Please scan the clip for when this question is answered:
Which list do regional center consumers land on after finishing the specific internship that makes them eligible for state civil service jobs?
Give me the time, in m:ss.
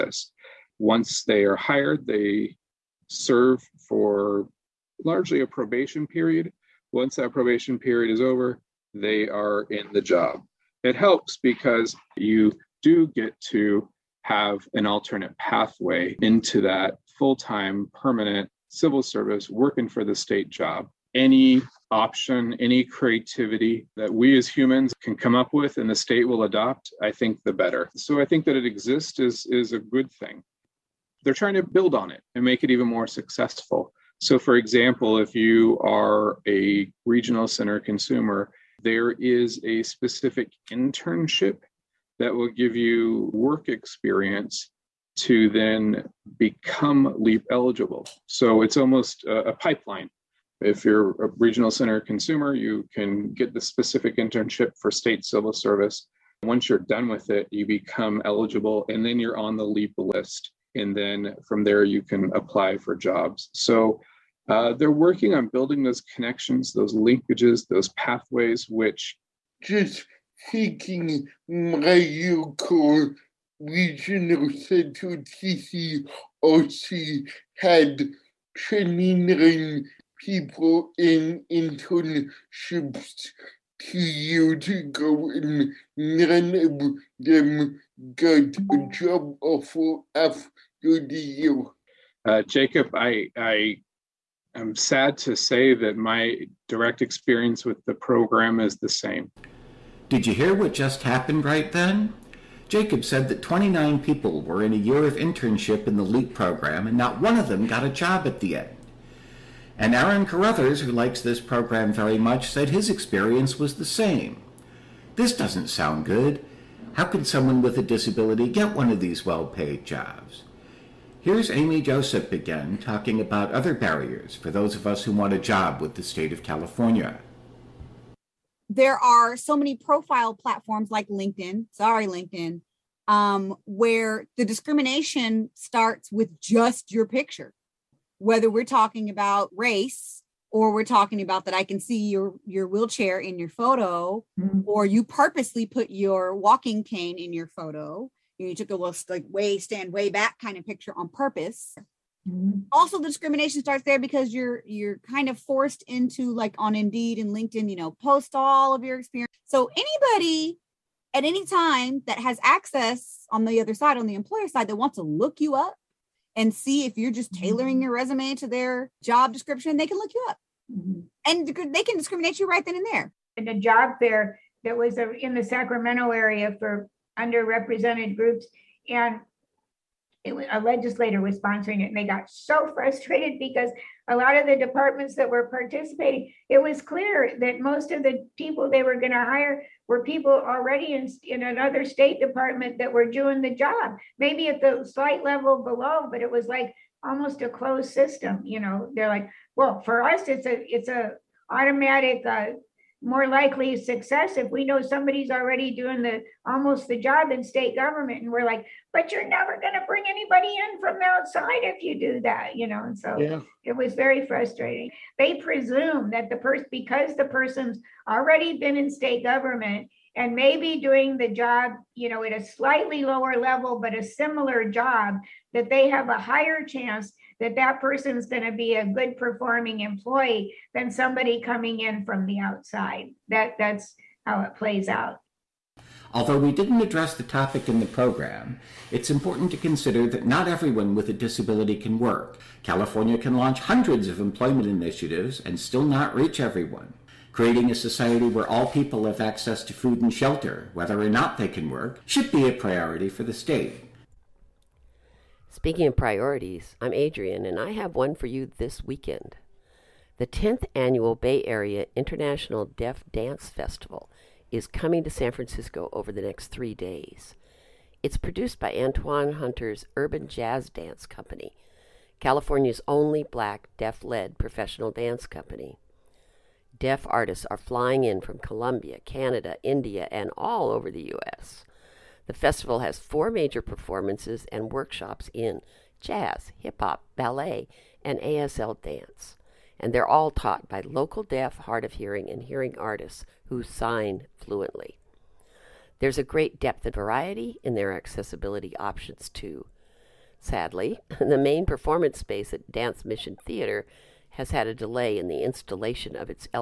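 0:59.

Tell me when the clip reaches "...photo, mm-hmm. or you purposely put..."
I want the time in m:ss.
2:23.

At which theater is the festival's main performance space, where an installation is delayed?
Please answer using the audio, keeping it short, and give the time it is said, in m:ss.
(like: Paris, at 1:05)
Dance Mission Theater, at 5:02.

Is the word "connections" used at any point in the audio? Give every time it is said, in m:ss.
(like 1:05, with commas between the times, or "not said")
1:06.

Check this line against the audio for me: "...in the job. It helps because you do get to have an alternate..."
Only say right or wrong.
right.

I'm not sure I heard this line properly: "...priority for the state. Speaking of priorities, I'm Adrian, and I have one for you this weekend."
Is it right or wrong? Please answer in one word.
right.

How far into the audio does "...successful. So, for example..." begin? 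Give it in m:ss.
0:33.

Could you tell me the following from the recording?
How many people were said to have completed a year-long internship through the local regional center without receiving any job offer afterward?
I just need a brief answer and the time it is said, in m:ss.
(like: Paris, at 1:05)
29, at 1:43.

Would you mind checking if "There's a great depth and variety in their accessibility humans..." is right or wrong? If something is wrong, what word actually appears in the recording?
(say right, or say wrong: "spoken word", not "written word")
wrong: "options", not "humans".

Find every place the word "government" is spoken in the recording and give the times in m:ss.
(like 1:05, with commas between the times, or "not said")
3:27, 3:39.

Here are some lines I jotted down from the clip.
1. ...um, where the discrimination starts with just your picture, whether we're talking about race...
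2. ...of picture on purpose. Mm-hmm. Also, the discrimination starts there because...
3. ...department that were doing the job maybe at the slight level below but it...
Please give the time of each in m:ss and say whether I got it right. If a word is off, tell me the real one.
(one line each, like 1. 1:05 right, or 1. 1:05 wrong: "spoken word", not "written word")
1. 2:13 right
2. 2:30 right
3. 3:12 right.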